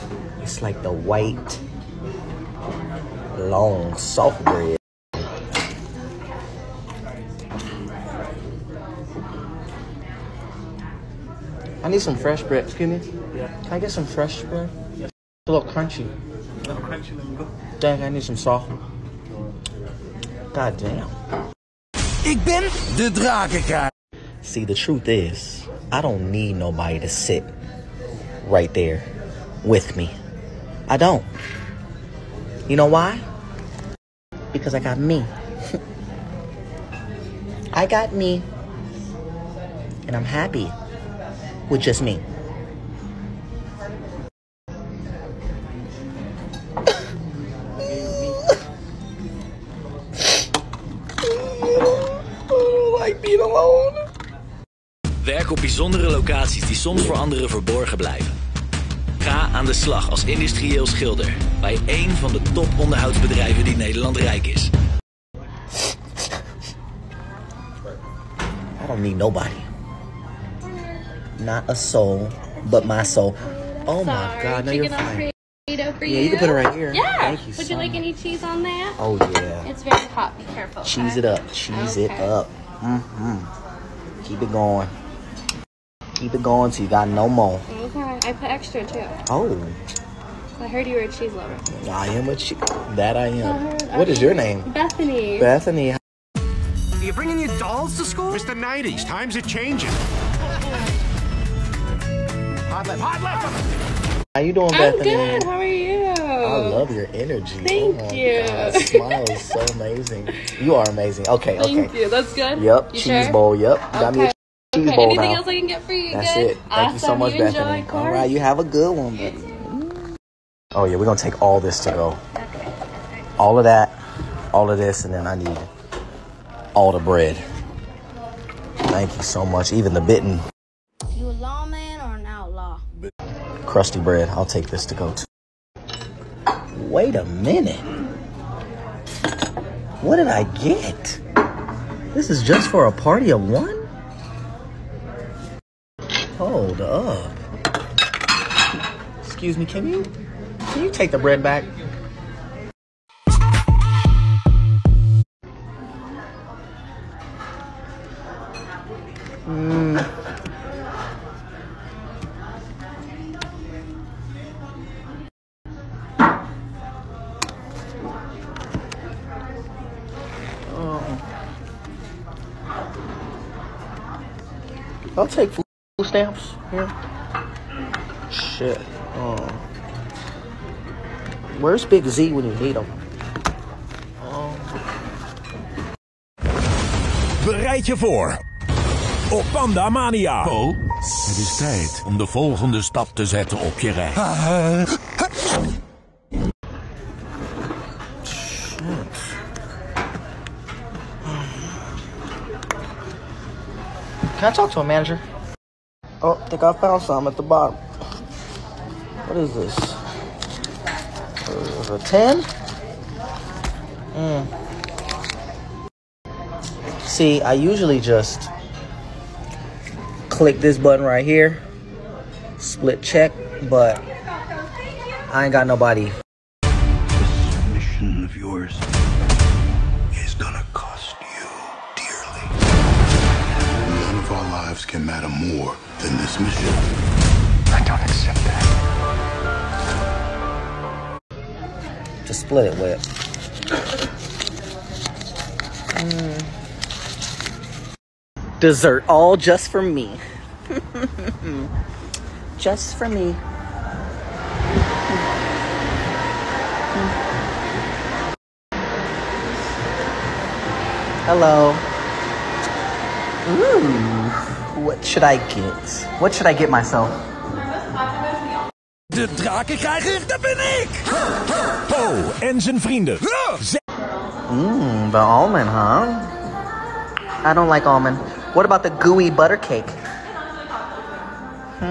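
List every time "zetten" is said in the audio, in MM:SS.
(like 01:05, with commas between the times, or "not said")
03:13.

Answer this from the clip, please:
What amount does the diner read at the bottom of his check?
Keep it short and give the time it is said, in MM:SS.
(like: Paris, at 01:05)
10, at 03:31.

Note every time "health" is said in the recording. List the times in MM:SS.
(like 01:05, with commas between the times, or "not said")
not said.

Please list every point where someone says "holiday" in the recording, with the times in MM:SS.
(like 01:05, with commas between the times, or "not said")
not said.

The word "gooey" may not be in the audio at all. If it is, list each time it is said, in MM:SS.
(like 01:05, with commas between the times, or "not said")
04:39.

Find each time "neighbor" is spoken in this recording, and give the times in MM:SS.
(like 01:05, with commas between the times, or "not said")
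not said.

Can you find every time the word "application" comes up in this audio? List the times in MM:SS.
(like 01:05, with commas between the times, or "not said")
not said.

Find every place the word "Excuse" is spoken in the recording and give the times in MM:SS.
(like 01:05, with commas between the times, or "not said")
00:12, 02:29.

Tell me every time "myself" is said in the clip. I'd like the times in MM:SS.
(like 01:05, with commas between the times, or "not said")
04:26.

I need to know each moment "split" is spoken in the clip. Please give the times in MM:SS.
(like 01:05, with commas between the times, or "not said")
03:42, 04:02.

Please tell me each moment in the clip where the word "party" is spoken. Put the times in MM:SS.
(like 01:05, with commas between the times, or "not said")
02:22.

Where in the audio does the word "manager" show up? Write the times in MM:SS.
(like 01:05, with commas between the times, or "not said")
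03:24.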